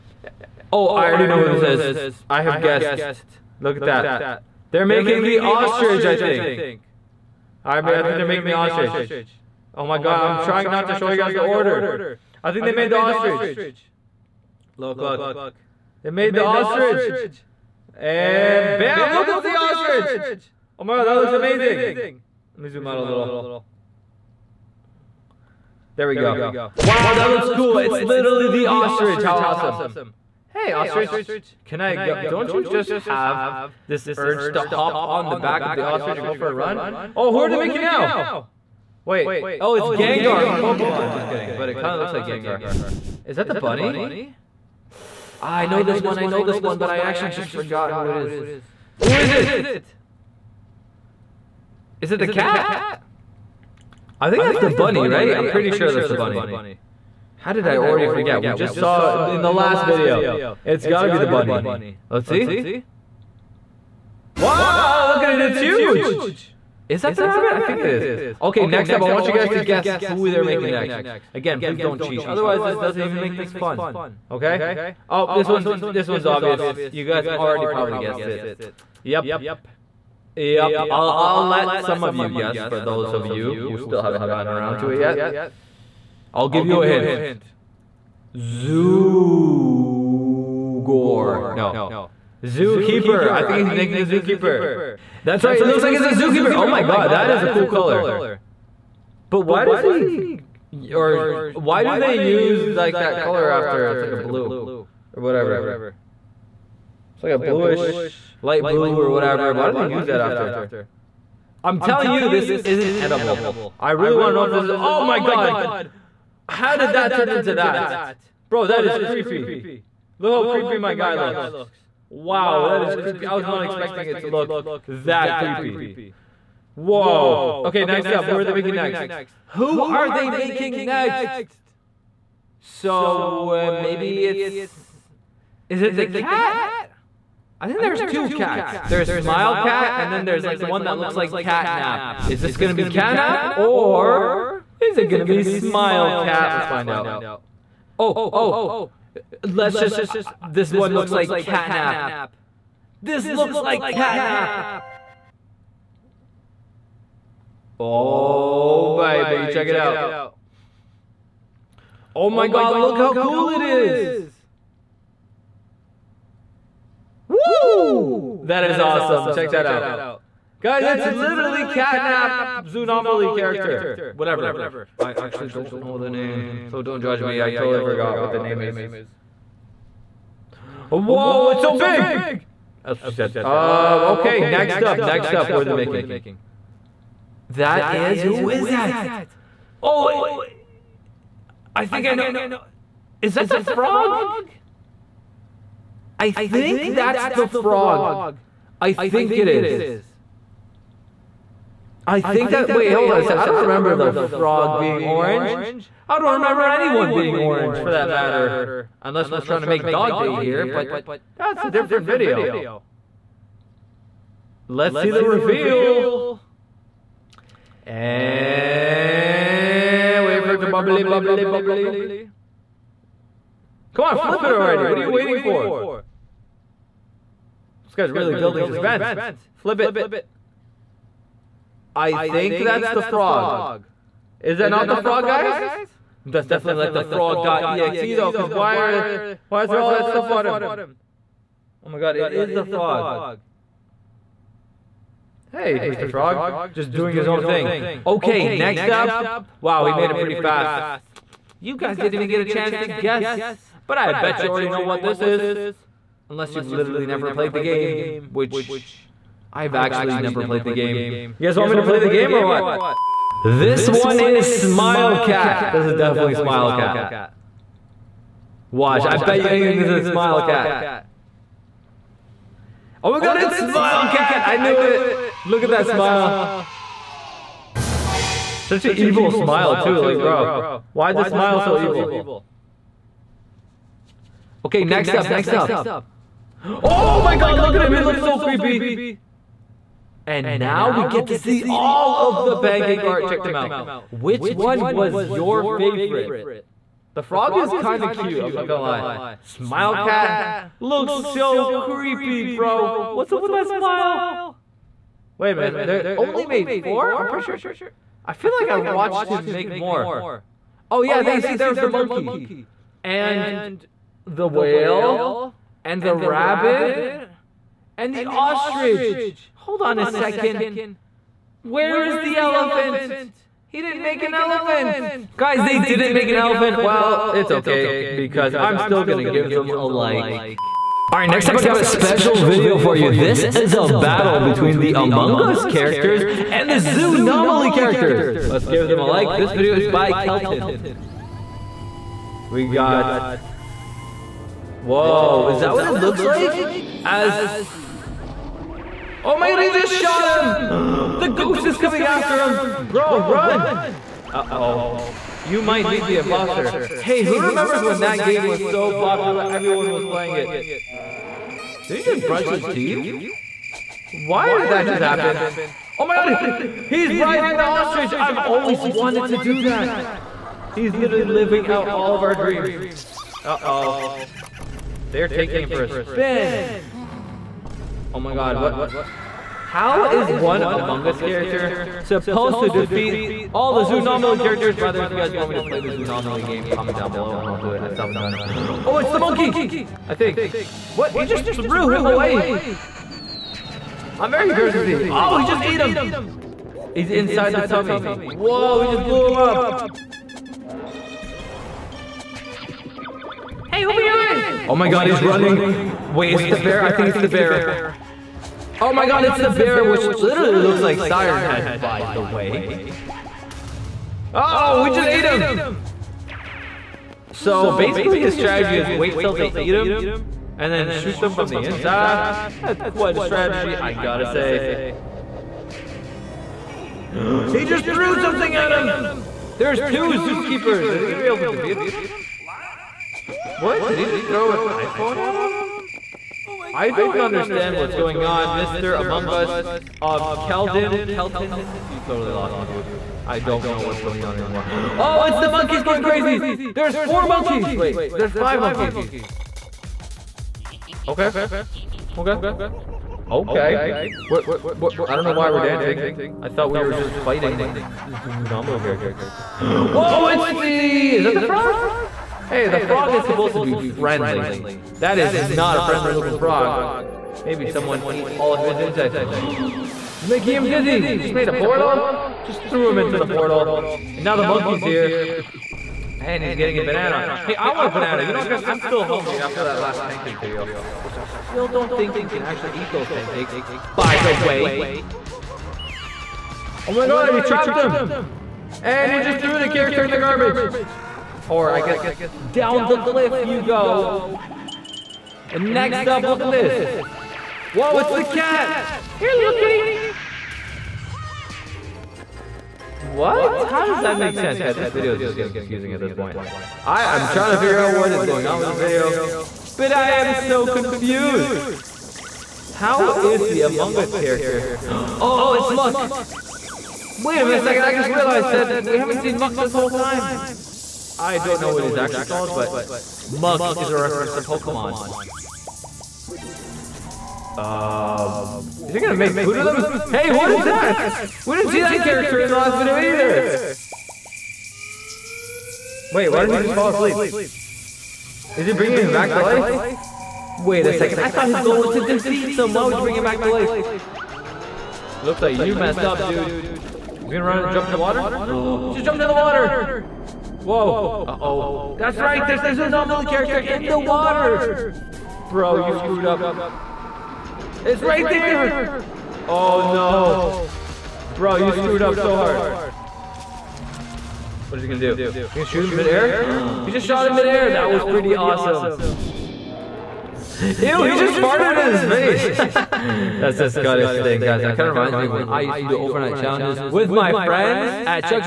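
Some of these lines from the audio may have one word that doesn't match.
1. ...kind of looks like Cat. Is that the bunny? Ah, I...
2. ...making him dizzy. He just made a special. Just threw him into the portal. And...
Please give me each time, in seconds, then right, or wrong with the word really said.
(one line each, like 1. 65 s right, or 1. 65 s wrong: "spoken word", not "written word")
1. 41 s wrong: "Gengar", not "Cat"
2. 470 s wrong: "portal", not "special".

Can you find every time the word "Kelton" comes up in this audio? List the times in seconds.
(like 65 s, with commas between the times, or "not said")
340 s, 441 s.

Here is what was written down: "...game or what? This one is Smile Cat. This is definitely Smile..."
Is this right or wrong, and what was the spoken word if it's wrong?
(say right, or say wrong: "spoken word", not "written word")
right.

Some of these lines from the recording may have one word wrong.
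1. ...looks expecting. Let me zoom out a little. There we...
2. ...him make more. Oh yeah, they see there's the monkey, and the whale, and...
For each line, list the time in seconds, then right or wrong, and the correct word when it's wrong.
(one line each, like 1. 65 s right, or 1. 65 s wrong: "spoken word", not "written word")
1. 21 s wrong: "amazing", not "expecting"
2. 309 s right.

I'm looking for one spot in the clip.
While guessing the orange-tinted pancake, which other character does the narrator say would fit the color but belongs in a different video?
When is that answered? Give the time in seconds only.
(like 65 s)
209 s.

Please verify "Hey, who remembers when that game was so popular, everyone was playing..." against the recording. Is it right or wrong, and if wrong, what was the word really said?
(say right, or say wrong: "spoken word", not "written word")
right.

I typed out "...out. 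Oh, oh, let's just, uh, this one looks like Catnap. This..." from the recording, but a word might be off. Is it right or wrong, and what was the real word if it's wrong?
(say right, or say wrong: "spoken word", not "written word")
right.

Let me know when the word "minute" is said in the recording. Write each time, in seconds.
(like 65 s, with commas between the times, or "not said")
305 s, 517 s.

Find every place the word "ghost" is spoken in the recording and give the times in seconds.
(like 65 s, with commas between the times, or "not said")
351 s.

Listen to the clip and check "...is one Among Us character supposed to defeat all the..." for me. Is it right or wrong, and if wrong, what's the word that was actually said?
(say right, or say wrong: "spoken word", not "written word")
right.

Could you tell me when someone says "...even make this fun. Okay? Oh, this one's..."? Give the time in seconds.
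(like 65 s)
73 s.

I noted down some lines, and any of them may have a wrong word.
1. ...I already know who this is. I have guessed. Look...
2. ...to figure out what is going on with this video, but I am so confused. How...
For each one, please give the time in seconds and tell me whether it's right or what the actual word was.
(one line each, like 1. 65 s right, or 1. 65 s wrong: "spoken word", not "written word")
1. 0 s right
2. 507 s right.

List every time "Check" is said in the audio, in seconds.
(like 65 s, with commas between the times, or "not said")
159 s, 169 s, 293 s.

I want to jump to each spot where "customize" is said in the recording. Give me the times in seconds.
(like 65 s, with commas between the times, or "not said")
not said.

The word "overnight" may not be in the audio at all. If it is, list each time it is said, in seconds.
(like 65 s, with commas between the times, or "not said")
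575 s.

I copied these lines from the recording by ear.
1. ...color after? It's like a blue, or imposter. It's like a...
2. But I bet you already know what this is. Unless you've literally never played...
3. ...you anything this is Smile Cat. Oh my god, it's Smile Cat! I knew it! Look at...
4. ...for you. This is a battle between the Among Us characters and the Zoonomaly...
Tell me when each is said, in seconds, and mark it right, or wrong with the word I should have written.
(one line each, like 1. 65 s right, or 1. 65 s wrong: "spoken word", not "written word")
1. 103 s wrong: "whatever", not "imposter"
2. 253 s right
3. 269 s right
4. 332 s right.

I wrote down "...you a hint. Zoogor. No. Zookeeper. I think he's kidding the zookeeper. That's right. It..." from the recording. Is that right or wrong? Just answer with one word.
wrong.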